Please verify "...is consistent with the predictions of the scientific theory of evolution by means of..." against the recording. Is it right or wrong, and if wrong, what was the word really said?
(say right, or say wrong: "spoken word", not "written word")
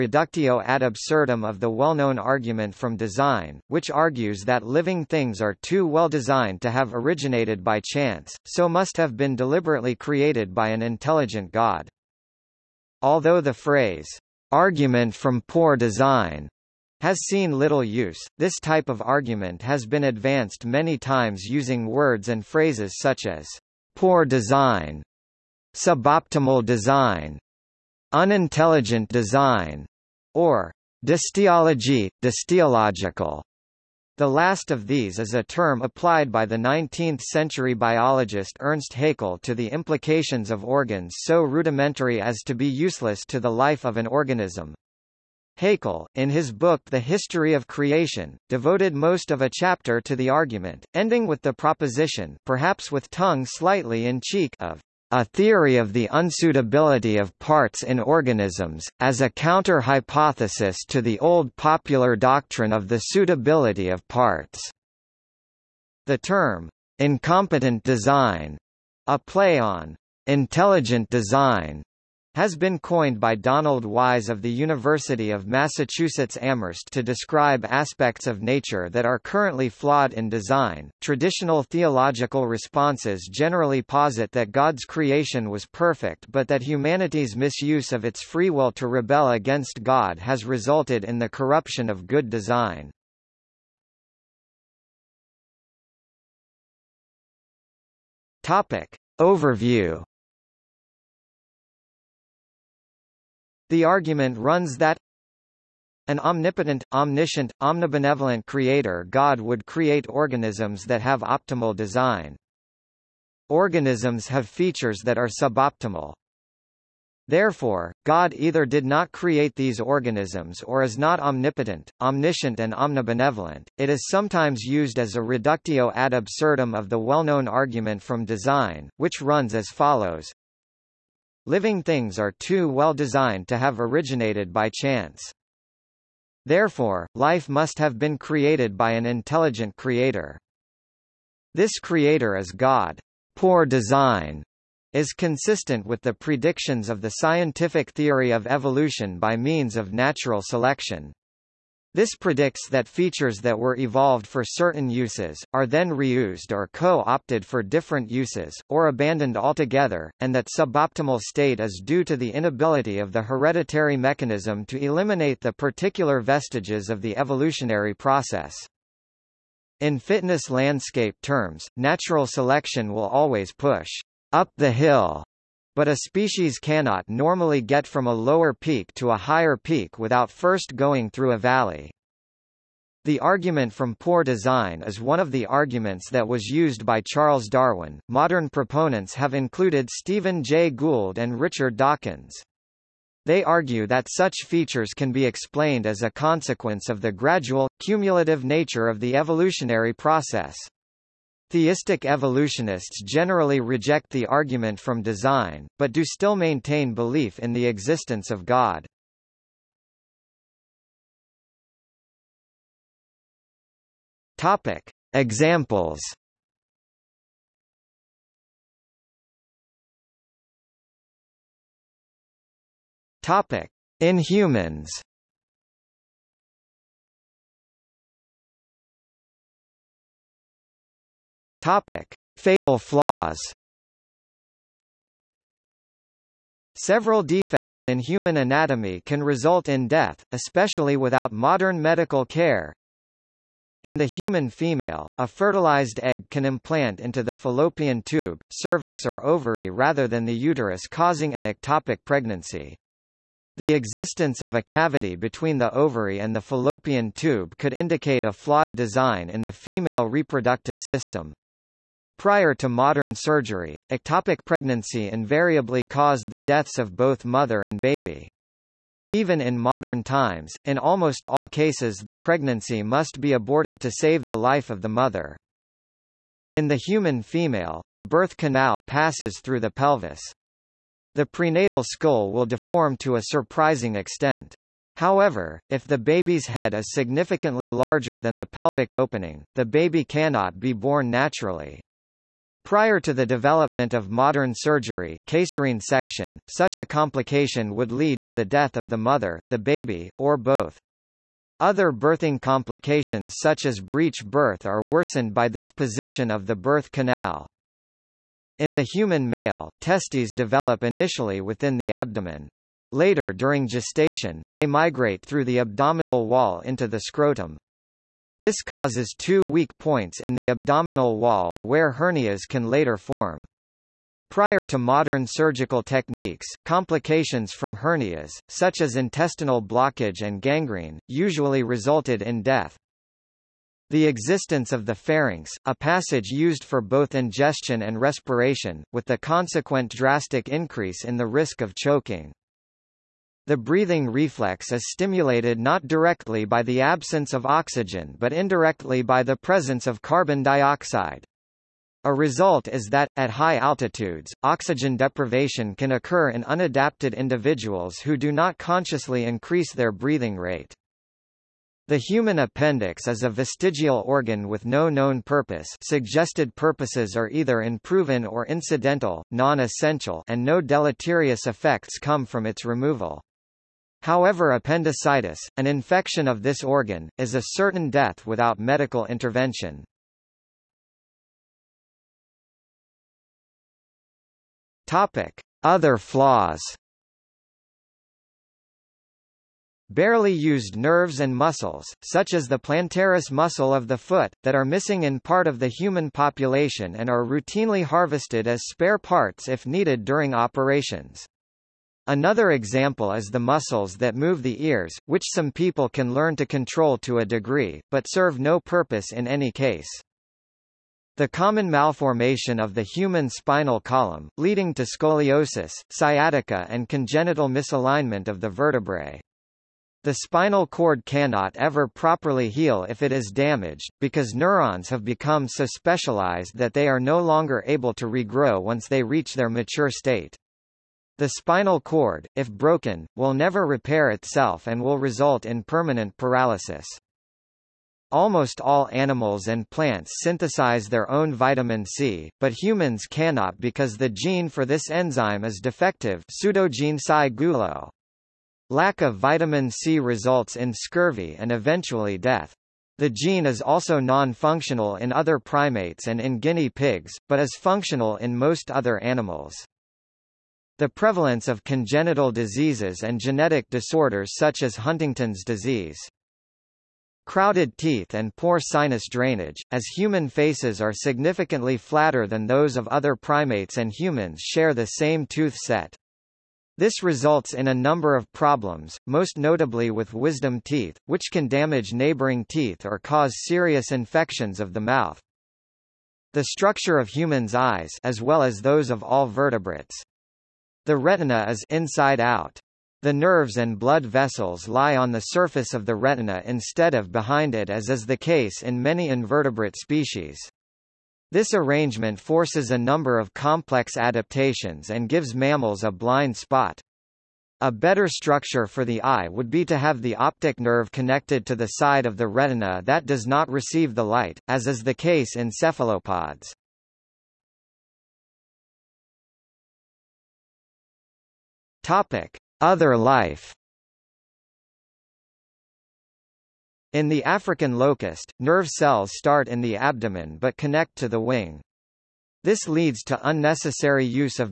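right.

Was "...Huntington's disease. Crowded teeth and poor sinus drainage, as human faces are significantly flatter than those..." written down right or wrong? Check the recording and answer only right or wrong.
right.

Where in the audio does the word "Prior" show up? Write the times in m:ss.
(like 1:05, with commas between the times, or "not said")
4:22, 4:52, 5:24.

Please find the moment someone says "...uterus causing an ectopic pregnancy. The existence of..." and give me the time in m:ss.
4:10.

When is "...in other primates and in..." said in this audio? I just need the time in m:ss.
7:34.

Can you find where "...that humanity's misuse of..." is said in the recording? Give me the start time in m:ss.
1:26.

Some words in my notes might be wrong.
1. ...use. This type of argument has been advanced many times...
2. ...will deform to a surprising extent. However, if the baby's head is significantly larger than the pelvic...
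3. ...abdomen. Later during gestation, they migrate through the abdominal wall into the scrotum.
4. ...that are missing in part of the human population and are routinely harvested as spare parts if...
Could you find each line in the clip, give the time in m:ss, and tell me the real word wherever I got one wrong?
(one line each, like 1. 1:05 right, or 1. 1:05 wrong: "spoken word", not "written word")
1. 0:17 right
2. 4:42 right
3. 5:11 right
4. 6:34 right.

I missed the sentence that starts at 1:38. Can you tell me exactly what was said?
Topic: Overview The argument runs that an omnipotent, omniscient, omnibenevolent creator God would create organisms that have optimal design.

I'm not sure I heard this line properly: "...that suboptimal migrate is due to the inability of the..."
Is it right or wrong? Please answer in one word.
wrong.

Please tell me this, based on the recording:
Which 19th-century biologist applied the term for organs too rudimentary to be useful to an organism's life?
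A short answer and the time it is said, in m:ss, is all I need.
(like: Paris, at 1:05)
Ernst Haeckel, at 0:38.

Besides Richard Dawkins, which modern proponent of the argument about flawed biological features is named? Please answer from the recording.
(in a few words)
Stephen Jay Gould.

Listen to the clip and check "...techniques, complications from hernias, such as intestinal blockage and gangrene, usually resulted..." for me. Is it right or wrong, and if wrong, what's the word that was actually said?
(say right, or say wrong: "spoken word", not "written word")
right.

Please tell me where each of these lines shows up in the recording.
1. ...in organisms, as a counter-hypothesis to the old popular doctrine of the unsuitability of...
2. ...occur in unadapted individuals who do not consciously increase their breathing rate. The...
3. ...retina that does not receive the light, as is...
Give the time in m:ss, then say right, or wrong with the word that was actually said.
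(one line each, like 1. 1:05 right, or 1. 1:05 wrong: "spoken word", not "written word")
1. 0:57 wrong: "suitability", not "unsuitability"
2. 5:55 right
3. 8:32 right.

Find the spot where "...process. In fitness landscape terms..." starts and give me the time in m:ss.
2:47.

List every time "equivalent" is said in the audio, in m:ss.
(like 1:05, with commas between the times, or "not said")
not said.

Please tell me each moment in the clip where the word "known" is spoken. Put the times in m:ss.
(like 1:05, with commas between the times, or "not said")
0:01, 2:06, 6:04.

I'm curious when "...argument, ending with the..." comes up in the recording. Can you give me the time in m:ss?
0:50.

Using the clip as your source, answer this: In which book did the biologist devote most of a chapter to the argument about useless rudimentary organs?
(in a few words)
The History of Creation.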